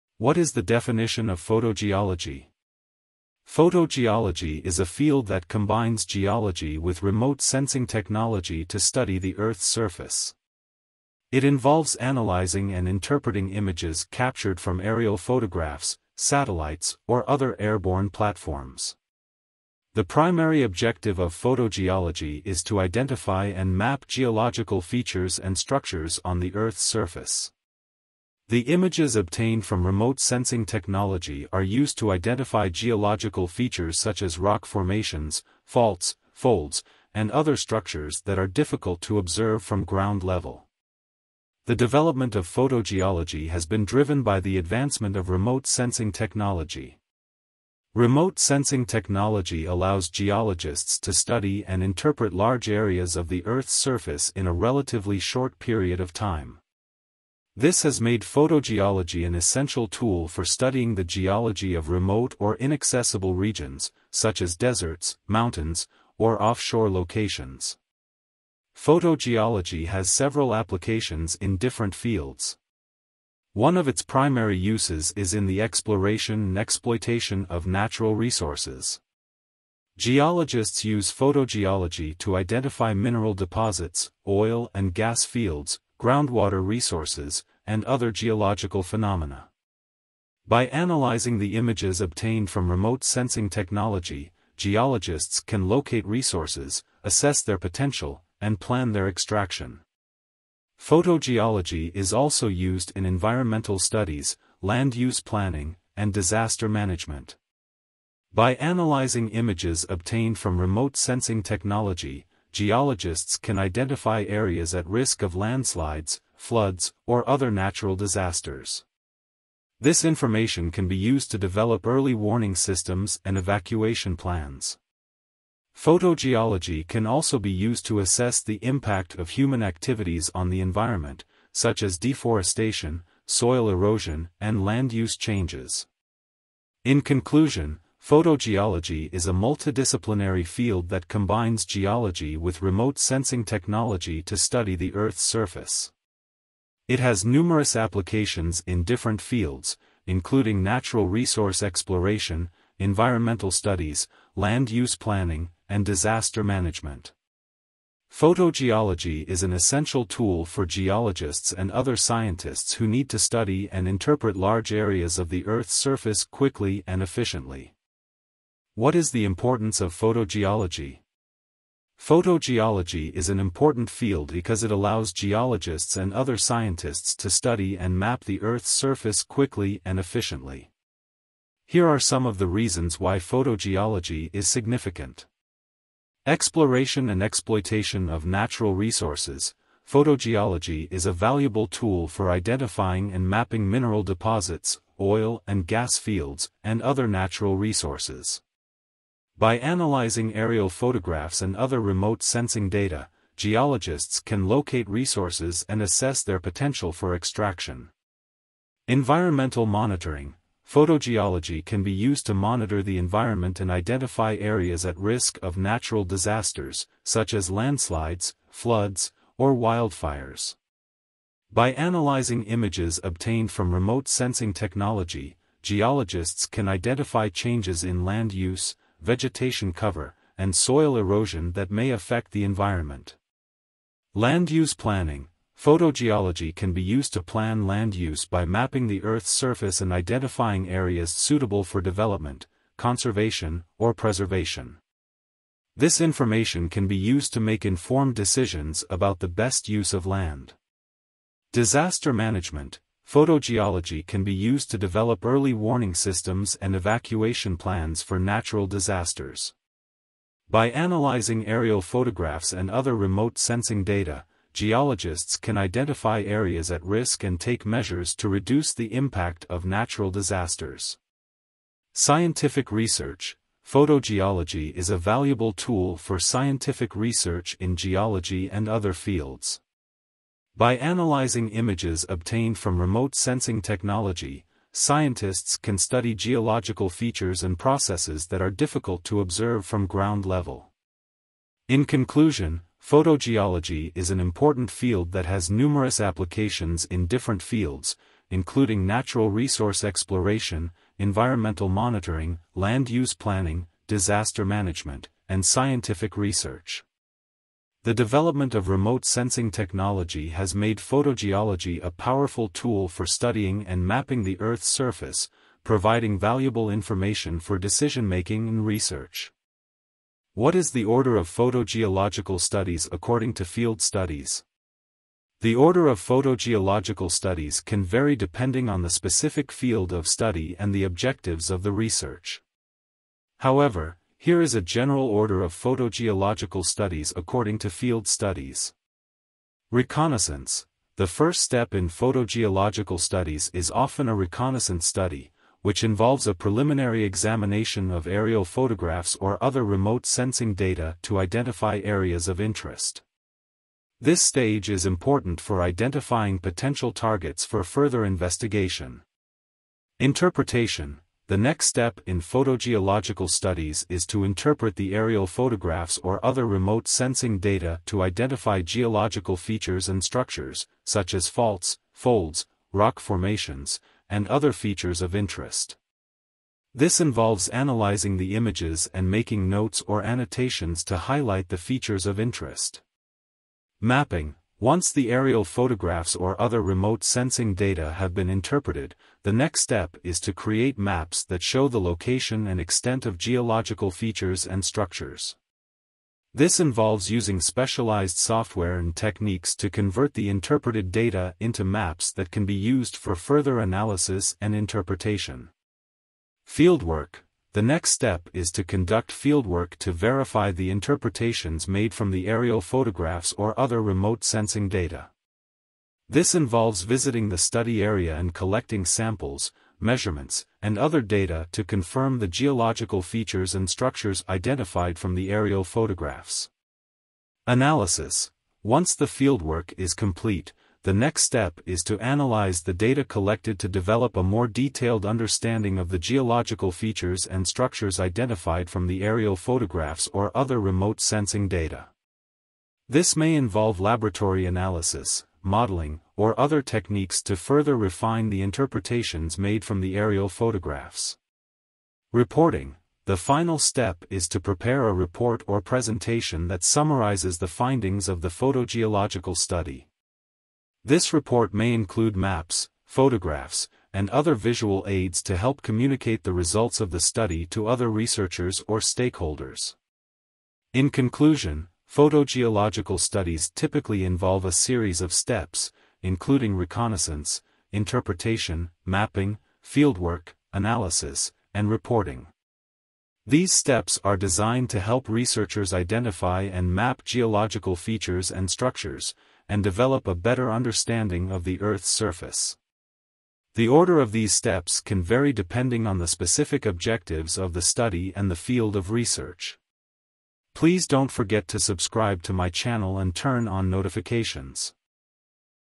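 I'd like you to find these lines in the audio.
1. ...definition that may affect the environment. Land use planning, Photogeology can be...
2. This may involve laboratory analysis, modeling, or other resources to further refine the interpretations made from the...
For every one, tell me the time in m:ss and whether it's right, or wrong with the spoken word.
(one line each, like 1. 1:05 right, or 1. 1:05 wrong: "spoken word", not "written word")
1. 3:50 wrong: "erosion", not "definition"
2. 7:22 wrong: "techniques", not "resources".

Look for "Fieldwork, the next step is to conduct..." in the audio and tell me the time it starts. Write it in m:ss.
6:46.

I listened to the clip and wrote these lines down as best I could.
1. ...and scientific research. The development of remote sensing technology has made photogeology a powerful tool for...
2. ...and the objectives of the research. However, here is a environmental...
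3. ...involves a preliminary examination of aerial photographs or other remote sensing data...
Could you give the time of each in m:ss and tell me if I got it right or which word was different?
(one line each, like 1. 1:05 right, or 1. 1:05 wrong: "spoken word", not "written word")
1. 5:05 right
2. 5:30 wrong: "general", not "environmental"
3. 5:45 right.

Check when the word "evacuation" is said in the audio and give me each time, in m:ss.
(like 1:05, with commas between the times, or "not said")
2:03, 4:16.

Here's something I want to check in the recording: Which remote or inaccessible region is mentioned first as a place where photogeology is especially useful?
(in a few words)
Deserts.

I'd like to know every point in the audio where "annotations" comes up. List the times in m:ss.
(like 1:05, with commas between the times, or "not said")
6:20.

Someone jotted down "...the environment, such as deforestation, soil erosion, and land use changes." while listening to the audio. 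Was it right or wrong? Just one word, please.
right.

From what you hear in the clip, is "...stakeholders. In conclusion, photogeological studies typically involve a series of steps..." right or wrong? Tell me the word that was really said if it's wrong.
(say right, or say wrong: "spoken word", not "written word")
right.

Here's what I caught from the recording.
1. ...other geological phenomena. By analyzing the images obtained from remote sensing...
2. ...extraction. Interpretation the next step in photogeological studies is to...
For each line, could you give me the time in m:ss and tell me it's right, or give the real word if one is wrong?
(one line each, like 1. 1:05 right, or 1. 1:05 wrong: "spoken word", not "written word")
1. 1:27 right
2. 5:58 wrong: "investigation", not "extraction".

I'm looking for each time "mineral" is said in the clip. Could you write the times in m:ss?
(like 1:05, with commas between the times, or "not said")
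1:22, 3:13.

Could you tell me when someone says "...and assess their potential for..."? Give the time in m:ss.
3:25.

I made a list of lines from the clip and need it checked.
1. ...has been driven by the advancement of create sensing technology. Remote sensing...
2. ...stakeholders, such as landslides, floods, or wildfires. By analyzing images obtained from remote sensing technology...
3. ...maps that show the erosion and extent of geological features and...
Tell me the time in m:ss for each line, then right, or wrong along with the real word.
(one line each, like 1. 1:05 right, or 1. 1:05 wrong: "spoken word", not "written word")
1. 0:43 wrong: "remote", not "create"
2. 3:36 wrong: "disasters", not "stakeholders"
3. 6:30 wrong: "location", not "erosion".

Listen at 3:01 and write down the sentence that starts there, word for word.
Here are some of the reasons why photogeology is significant.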